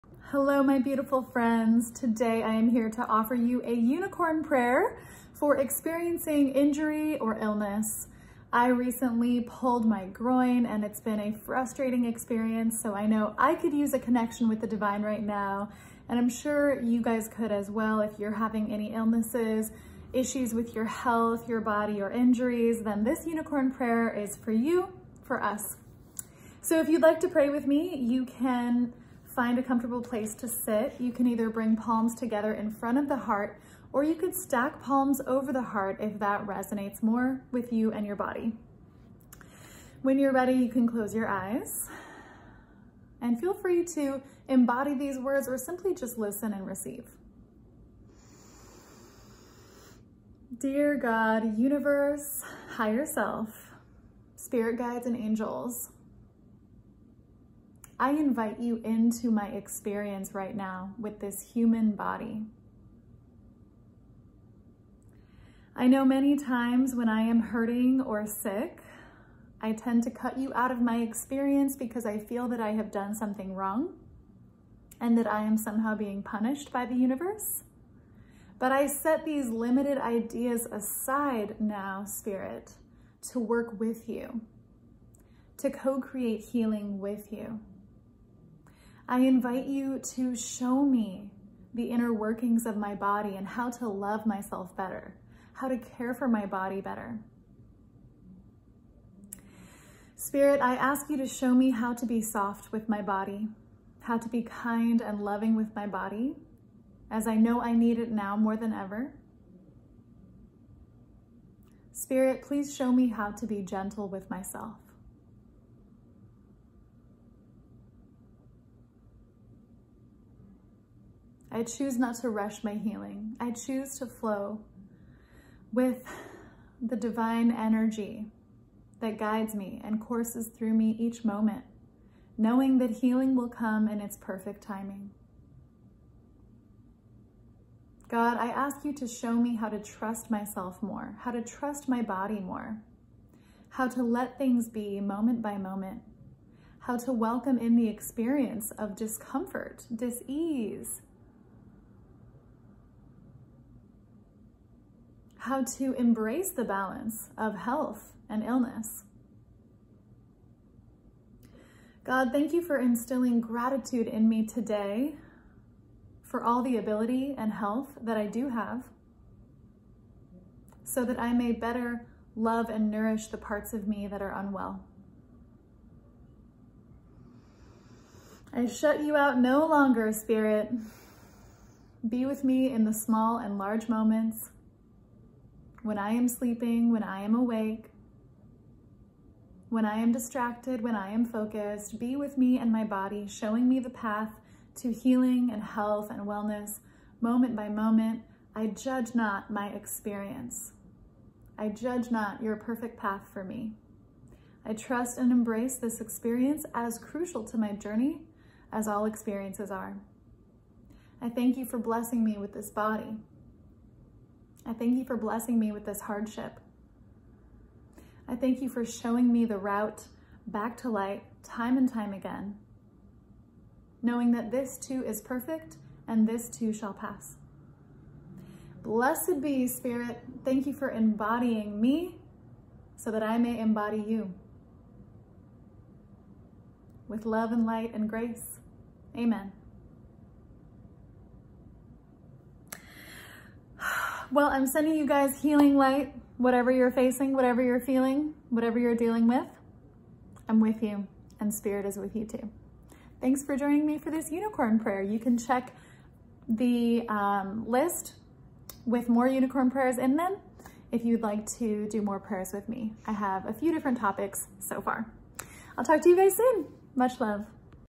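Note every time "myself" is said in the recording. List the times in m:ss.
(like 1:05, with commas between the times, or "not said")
1:34, 1:54, 2:20.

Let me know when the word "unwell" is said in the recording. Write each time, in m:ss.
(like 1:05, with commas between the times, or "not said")
2:54.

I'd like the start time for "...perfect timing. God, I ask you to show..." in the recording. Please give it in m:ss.
2:14.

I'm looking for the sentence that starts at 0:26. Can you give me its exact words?
So if you'd like to pray with me, you can Find a comfortable place to sit.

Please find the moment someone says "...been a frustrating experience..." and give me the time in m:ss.
0:11.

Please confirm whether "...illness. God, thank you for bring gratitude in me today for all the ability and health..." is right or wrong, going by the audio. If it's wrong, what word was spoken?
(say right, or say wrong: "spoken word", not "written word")
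wrong: "instilling", not "bring".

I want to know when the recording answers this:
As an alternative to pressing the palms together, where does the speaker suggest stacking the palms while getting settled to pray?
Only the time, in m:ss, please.
0:35.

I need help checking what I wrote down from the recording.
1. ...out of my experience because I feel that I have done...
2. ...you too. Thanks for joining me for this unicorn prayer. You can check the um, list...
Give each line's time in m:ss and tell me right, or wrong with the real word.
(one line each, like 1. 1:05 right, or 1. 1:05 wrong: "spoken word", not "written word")
1. 1:10 right
2. 4:12 right.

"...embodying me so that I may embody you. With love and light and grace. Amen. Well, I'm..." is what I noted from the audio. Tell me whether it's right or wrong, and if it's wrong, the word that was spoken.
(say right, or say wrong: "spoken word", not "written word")
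right.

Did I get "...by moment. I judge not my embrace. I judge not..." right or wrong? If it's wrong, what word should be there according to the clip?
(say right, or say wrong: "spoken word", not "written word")
wrong: "experience", not "embrace".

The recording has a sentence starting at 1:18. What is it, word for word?
But I set these limited ideas aside now, Spirit, to work with you, to co-create healing with you.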